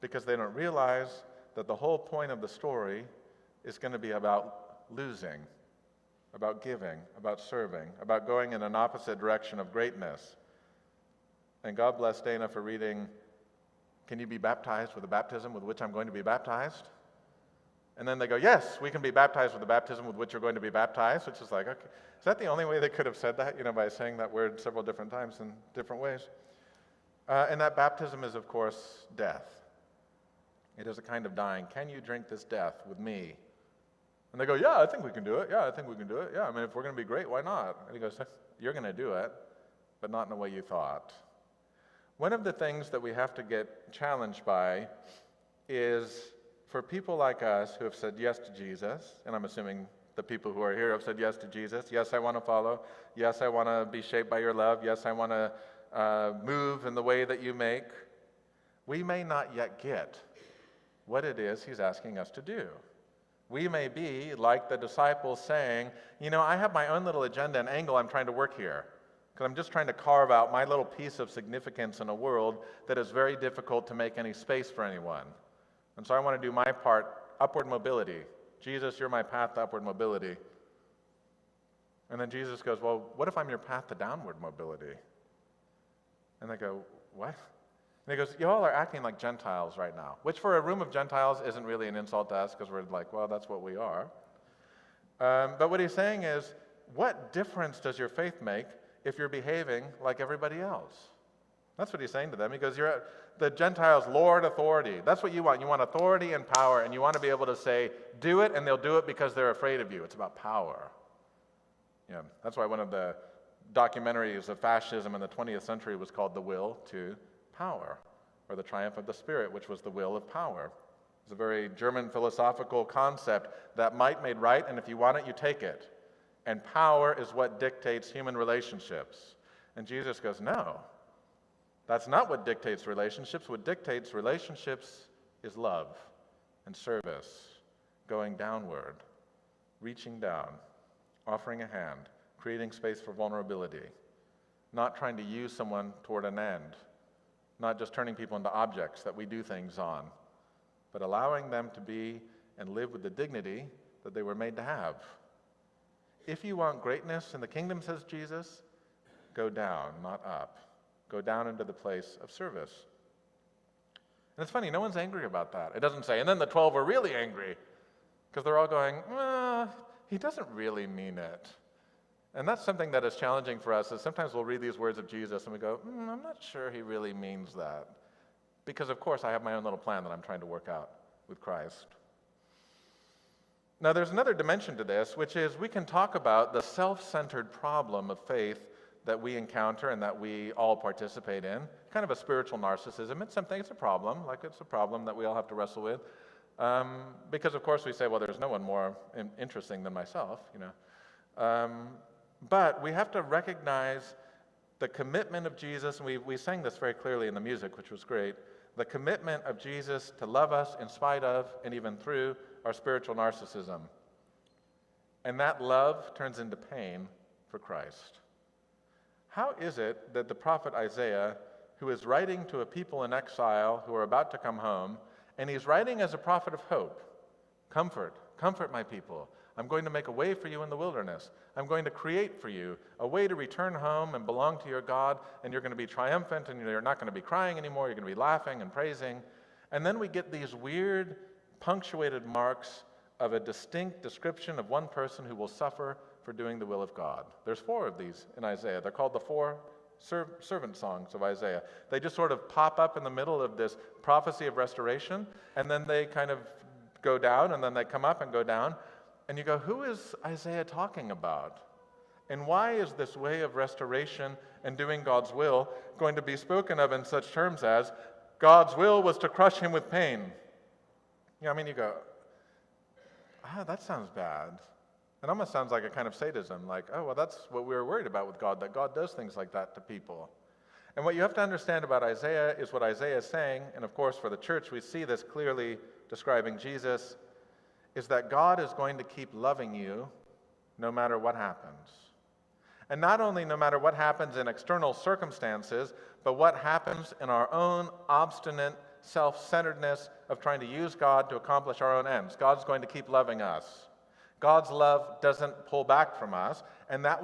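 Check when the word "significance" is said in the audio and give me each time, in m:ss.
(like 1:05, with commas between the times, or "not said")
1:11.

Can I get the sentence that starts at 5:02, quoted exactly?
God's going to keep loving us.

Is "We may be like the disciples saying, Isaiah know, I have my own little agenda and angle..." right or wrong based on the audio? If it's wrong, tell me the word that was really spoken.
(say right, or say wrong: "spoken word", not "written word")
wrong: "You", not "Isaiah".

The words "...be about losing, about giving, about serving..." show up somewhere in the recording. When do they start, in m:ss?
0:03.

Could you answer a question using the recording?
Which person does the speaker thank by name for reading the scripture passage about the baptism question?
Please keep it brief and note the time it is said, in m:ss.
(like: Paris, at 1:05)
Dana, at 0:12.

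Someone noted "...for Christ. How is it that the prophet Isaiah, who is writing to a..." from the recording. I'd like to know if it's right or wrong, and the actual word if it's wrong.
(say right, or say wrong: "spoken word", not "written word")
right.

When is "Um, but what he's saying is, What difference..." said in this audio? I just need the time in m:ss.
1:35.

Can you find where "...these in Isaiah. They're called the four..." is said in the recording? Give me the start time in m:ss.
4:07.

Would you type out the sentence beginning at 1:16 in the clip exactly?
And so I want to do my part upward mobility.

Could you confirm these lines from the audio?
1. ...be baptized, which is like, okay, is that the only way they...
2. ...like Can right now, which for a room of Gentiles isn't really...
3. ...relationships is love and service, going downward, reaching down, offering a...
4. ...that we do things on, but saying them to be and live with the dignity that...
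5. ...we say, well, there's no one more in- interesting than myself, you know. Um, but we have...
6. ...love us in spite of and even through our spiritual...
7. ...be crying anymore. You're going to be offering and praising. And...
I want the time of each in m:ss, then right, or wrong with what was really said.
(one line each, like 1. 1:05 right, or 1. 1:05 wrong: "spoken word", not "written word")
1. 0:20 right
2. 1:29 wrong: "Gentiles", not "Can"
3. 2:14 right
4. 2:29 wrong: "allowing", not "saying"
5. 3:17 right
6. 3:30 right
7. 3:57 wrong: "laughing", not "offering".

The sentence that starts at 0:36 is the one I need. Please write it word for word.
Yeah, I mean, if we're going to be great, why not?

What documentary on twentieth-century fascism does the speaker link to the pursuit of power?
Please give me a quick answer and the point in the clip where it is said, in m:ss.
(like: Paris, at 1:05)
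The Will to Power, at 1:56.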